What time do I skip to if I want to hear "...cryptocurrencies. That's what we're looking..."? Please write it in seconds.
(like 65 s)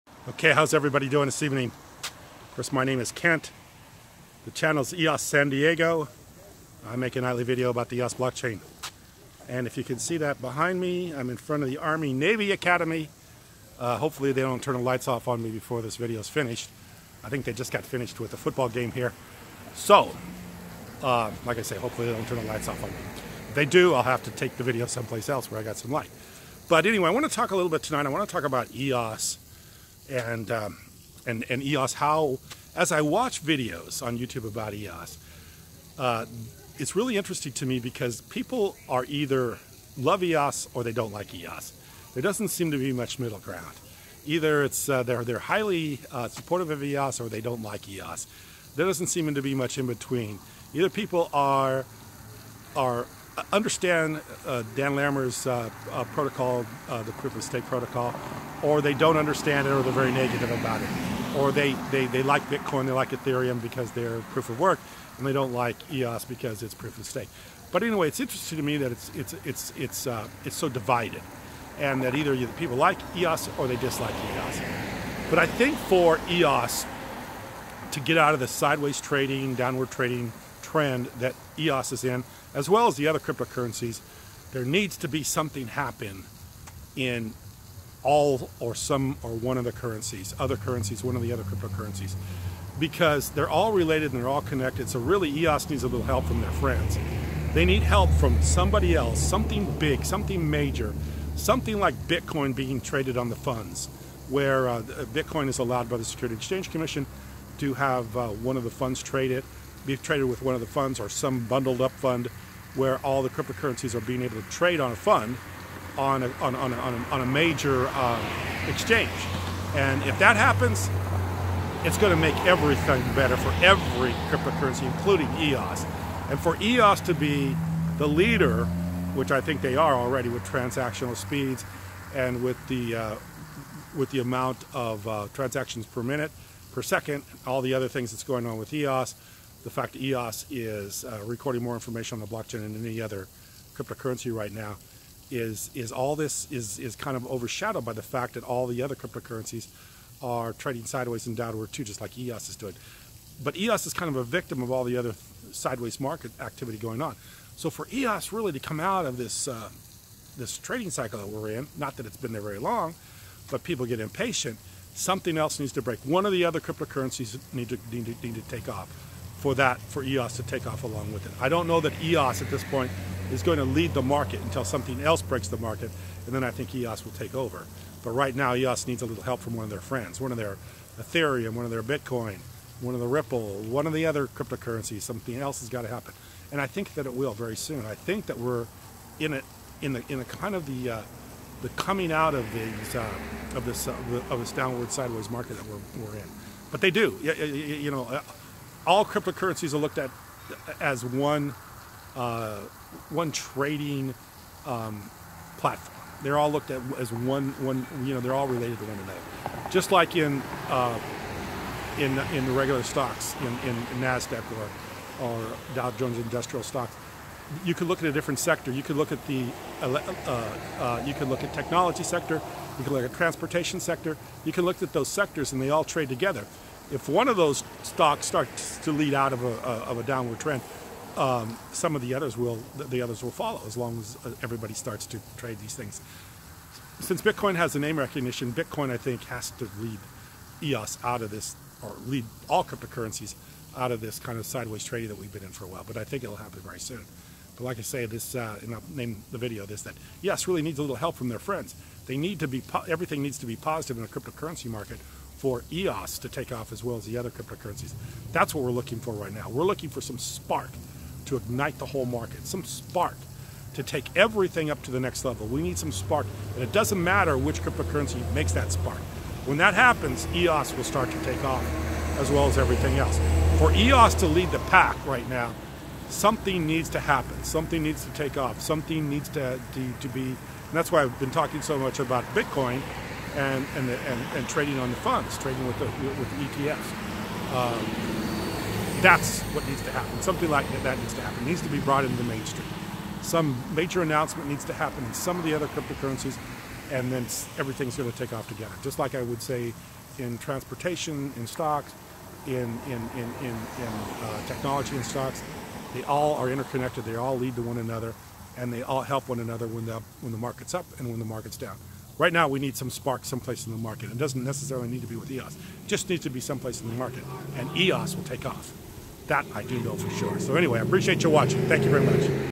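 257 s.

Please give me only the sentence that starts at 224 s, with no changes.
You can look at those sectors, and they all trade together.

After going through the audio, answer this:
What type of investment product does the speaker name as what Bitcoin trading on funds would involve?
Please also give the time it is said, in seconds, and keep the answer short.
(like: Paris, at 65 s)
ETFs, at 286 s.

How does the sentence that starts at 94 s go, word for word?
So really EOS needs a little help from their friends.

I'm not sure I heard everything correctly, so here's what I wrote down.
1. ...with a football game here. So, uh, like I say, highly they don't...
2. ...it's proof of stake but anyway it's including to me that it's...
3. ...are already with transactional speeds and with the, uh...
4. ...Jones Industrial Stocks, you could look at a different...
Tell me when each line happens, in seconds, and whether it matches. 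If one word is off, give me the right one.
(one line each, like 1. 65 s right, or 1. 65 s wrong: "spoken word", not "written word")
1. 18 s wrong: "hopefully", not "highly"
2. 66 s wrong: "interesting", not "including"
3. 129 s right
4. 215 s right.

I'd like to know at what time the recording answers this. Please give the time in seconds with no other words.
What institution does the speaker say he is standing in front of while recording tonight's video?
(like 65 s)
11 s.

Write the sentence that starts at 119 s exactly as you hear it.
And if that happens, it's going to make everything better for every cryptocurrency, including EOS.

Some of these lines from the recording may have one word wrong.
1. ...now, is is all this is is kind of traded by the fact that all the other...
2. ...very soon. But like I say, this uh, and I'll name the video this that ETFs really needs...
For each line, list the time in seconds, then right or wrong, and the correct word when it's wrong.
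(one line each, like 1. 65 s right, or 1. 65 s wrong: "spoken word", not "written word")
1. 144 s wrong: "overshadowed", not "traded"
2. 246 s wrong: "EOS", not "ETFs".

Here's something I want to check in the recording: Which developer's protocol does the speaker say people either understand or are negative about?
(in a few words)
Dan Larimer.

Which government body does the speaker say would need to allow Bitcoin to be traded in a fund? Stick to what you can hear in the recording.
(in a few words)
Security Exchange Commission.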